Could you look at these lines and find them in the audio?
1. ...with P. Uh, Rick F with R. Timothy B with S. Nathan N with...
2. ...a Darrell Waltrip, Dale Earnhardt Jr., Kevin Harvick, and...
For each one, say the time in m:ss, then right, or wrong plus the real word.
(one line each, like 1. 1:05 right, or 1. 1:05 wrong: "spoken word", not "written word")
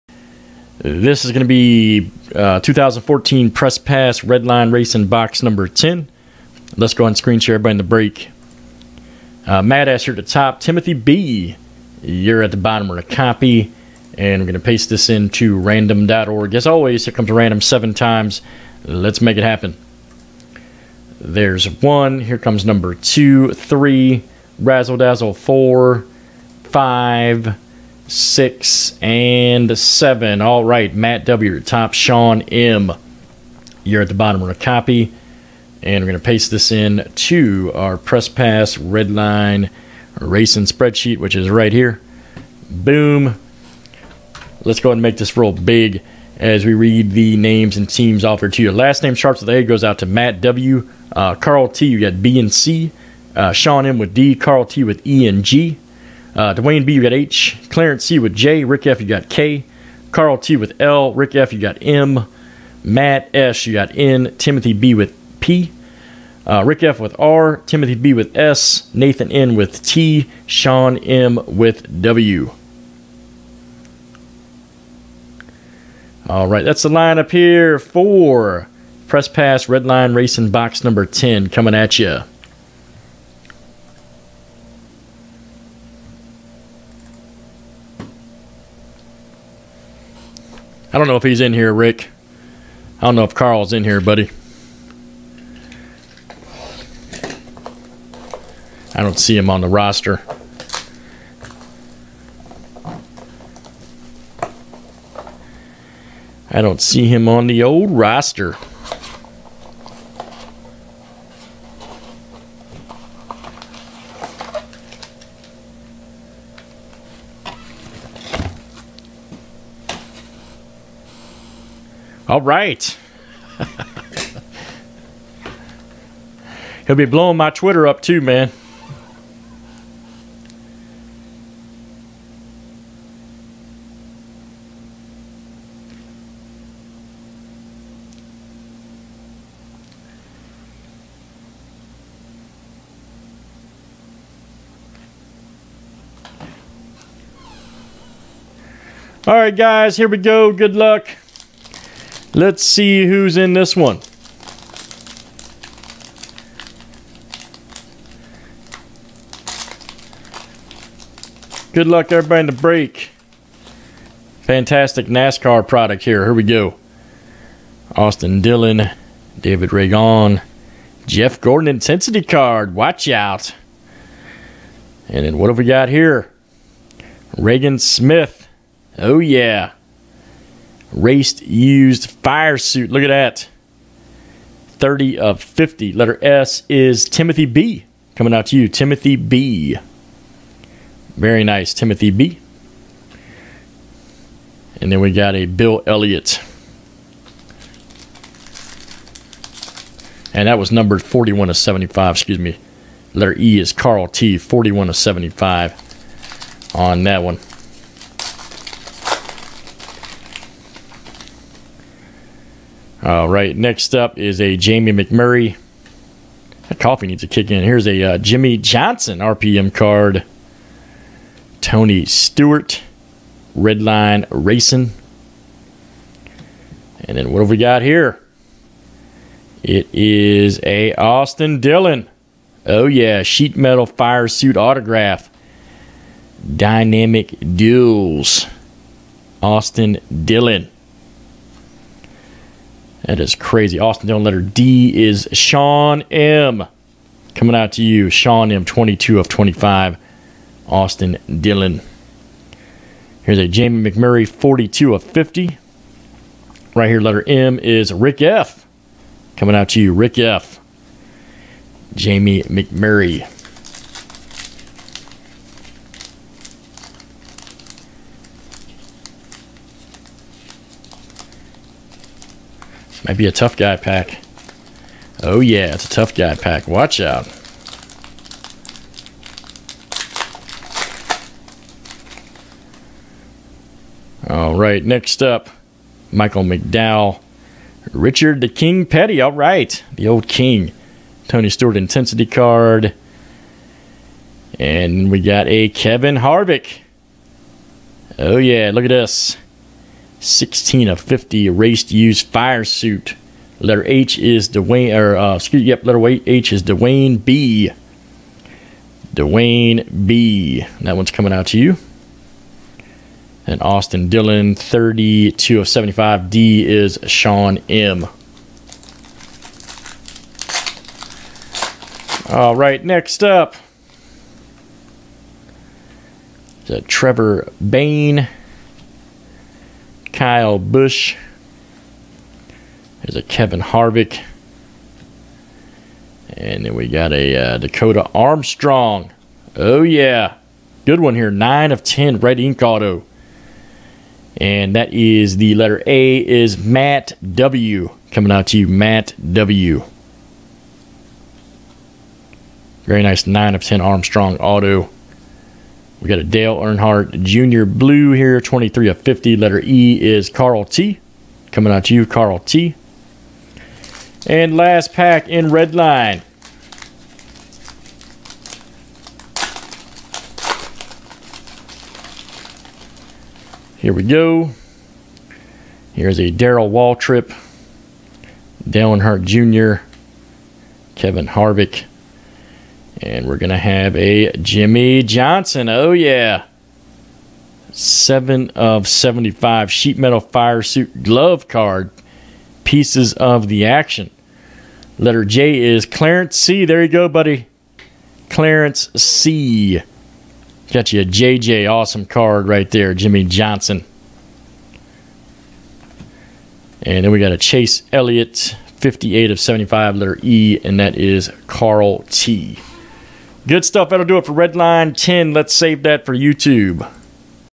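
1. 1:04 right
2. 6:16 right.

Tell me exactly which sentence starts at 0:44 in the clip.
Let's go ahead and make this real big as we read the names and teams offered to you.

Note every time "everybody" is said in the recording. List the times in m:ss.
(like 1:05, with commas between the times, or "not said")
0:07, 2:42.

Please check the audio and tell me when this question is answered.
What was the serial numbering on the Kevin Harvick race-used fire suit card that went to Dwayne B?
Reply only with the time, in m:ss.
5:00.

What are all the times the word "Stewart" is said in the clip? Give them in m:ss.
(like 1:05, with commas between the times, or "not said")
3:42, 4:51.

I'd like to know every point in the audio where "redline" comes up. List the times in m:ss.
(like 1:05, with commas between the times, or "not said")
0:38, 3:43, 6:54.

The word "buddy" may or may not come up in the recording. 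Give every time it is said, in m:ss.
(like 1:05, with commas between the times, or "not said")
1:34, 6:37.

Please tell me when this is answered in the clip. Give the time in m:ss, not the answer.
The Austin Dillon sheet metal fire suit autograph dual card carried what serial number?
4:08.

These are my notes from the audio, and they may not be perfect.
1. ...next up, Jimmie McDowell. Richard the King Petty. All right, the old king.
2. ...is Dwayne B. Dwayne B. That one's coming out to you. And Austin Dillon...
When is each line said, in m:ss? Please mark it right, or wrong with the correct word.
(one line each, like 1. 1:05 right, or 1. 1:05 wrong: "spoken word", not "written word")
1. 4:44 wrong: "Michael", not "Jimmie"
2. 5:06 right.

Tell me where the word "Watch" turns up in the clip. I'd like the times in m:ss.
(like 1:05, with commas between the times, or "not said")
2:52, 4:36.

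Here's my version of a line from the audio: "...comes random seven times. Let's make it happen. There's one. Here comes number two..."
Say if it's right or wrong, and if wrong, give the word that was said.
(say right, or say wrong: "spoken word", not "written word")
right.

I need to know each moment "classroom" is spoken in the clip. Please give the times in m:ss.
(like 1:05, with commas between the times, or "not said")
not said.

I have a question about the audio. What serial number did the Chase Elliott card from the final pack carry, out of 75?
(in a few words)
58.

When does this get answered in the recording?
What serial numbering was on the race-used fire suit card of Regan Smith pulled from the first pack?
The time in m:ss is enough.
3:04.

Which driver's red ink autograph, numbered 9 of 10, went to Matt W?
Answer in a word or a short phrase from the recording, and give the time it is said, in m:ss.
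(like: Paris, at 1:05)
Dakota Armstrong, at 5:37.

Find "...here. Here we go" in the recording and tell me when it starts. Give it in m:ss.
2:46.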